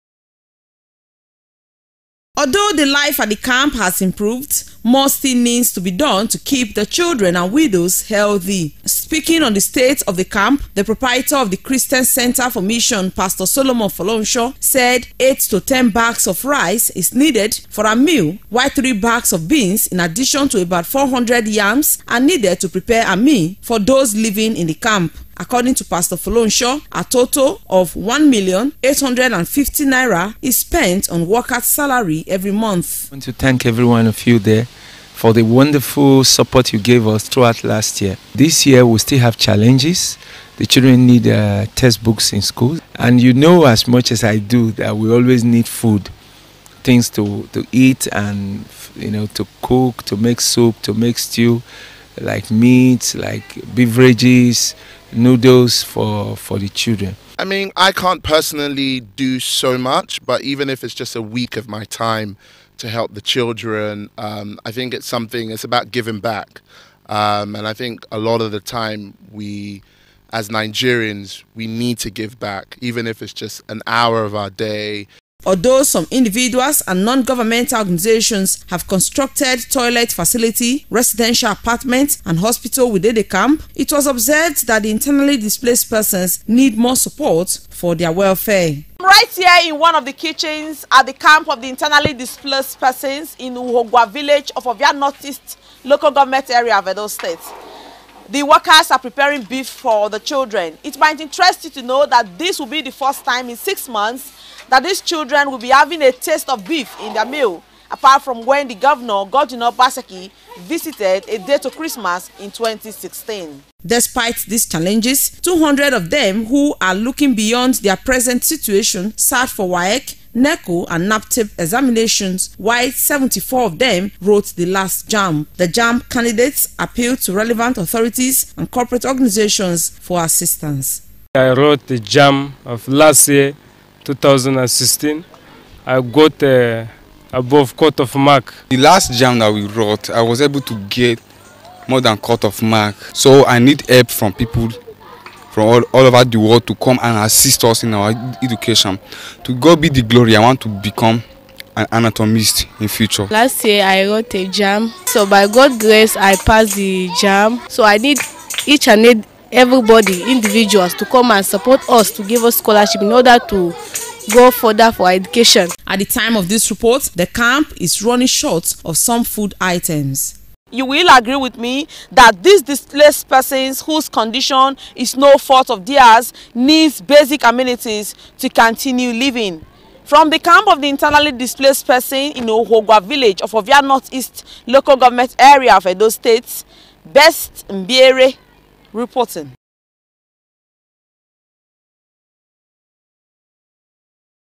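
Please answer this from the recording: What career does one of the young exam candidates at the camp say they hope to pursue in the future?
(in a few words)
anatomist.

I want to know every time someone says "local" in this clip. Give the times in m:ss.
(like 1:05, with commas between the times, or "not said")
1:35, 3:04.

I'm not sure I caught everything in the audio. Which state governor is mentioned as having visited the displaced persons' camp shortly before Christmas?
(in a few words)
Godwin Obaseki.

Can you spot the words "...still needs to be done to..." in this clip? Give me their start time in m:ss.
0:05.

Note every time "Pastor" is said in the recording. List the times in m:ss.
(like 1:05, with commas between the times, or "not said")
0:13, 0:25.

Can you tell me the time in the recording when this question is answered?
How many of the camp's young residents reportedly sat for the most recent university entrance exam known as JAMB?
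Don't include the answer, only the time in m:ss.
2:02.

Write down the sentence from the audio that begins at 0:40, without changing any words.
The children need uh, textbooks in school.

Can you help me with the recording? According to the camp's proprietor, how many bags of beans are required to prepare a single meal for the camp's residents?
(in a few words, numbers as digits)
3.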